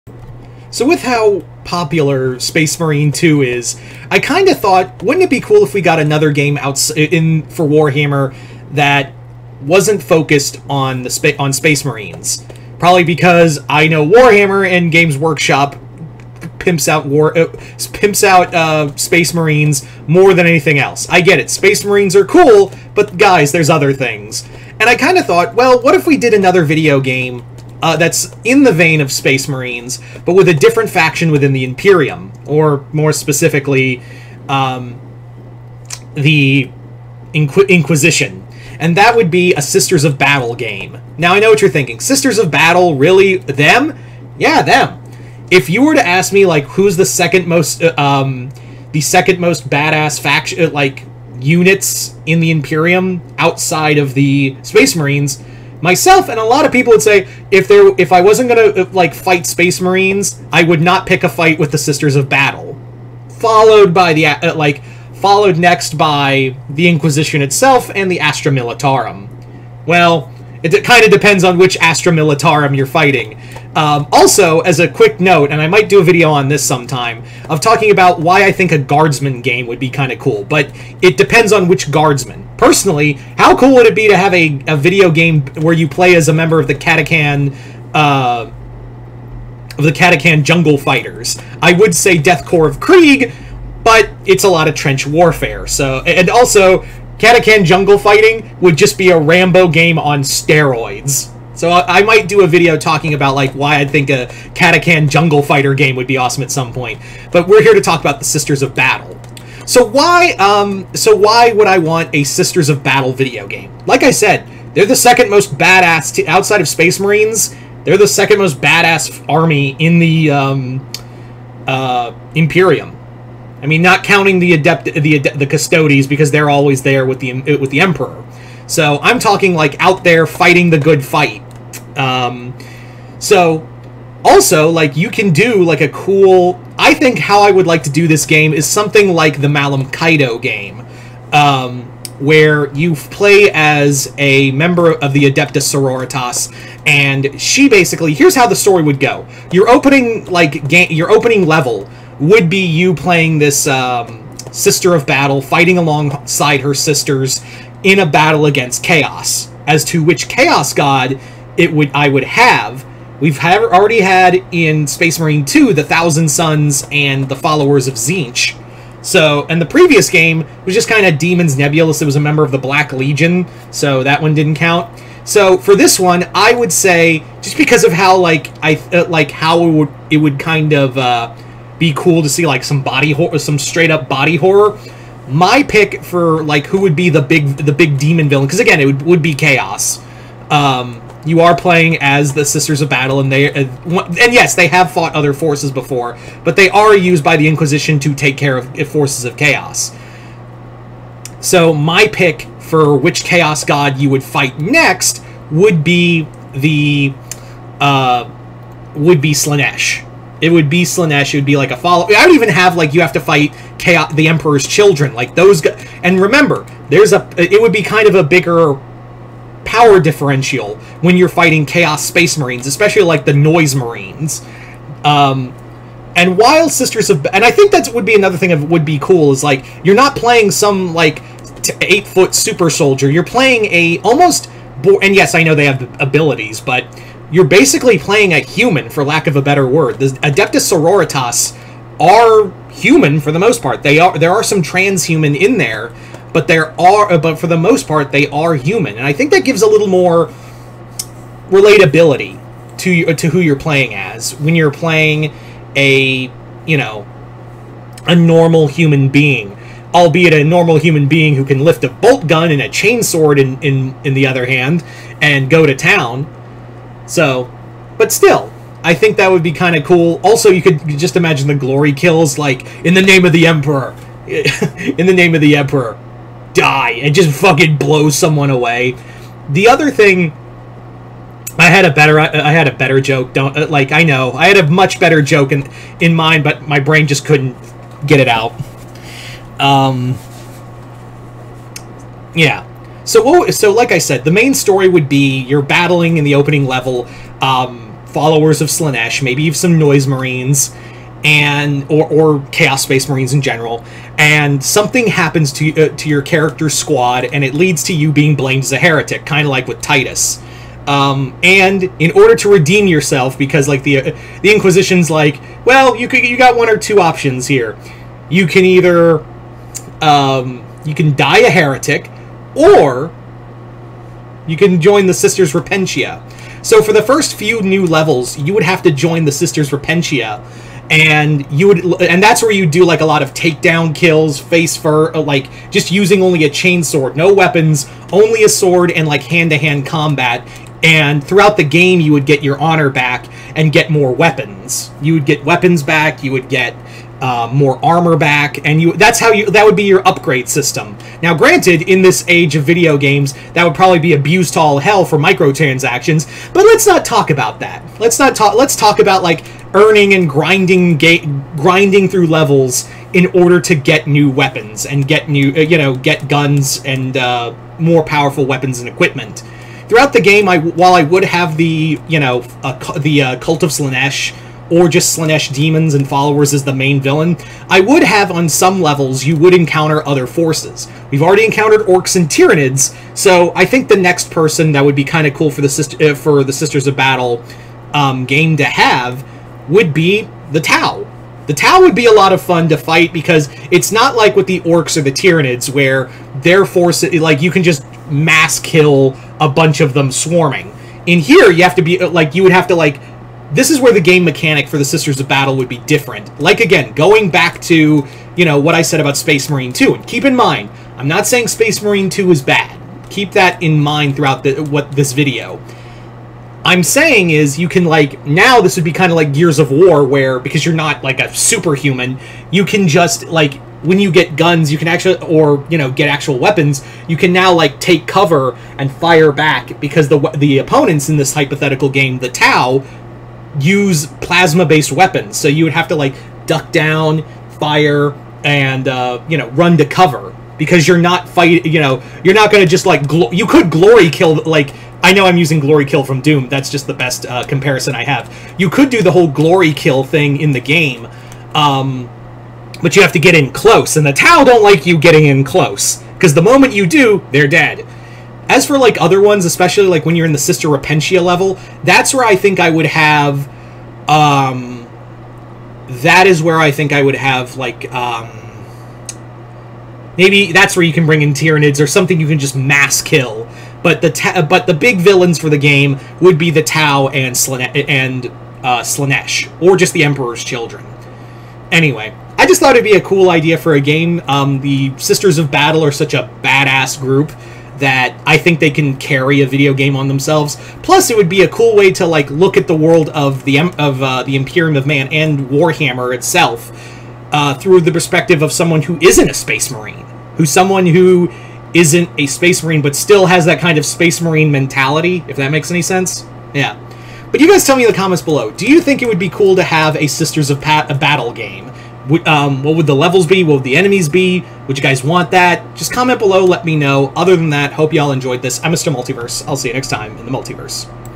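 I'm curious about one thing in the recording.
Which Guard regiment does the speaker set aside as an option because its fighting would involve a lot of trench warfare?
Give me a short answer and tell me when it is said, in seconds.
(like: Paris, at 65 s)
Death Corps of Krieg, at 92 s.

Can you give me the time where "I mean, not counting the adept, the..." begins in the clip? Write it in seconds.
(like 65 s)
123 s.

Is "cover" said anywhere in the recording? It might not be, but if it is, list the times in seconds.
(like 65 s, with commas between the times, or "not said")
428 s, 439 s.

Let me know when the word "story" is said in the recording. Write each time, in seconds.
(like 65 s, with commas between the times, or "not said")
148 s, 294 s.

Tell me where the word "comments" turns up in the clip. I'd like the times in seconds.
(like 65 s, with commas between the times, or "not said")
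507 s, 515 s.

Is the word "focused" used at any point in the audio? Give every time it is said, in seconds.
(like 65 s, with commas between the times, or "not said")
10 s.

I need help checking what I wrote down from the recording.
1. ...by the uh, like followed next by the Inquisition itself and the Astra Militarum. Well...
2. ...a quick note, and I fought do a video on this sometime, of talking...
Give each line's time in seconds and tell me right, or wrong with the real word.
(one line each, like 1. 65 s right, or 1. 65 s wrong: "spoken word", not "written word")
1. 63 s right
2. 74 s wrong: "might", not "fought".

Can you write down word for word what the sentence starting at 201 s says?
So my pick for which chaos god you would fight next would be the uh, would be Slaanesh.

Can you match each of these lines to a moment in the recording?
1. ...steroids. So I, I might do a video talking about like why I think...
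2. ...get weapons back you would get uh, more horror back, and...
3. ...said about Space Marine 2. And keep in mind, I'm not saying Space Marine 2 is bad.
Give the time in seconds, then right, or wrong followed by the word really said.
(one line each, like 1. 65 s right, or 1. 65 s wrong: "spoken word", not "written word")
1. 100 s right
2. 345 s wrong: "armor", not "horror"
3. 408 s right.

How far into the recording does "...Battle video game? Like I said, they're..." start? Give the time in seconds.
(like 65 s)
112 s.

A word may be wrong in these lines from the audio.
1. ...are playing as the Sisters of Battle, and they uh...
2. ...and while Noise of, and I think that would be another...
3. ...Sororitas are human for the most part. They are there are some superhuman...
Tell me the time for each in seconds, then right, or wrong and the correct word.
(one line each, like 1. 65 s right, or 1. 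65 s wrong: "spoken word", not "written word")
1. 191 s right
2. 226 s wrong: "Sisters", not "Noise"
3. 240 s wrong: "transhuman", not "superhuman".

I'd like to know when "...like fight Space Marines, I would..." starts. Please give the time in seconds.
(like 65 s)
58 s.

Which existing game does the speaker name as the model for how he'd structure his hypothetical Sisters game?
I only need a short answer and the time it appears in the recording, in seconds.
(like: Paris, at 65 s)
Malum Kaido, at 139 s.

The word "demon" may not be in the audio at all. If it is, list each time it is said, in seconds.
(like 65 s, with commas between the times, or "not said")
171 s, 187 s, 375 s.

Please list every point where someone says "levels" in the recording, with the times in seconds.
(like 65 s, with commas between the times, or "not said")
151 s, 296 s, 327 s, 362 s, 378 s, 461 s, 512 s.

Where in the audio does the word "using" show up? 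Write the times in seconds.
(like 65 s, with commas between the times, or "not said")
335 s, 445 s.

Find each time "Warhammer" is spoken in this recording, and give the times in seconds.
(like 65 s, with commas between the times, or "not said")
7 s, 14 s, 495 s.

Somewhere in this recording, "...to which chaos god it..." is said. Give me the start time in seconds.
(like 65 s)
159 s.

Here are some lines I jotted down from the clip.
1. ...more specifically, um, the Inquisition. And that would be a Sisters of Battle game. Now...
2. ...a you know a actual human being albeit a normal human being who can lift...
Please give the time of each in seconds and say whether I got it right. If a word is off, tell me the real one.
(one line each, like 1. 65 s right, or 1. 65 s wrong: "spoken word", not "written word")
1. 32 s right
2. 255 s wrong: "normal", not "actual".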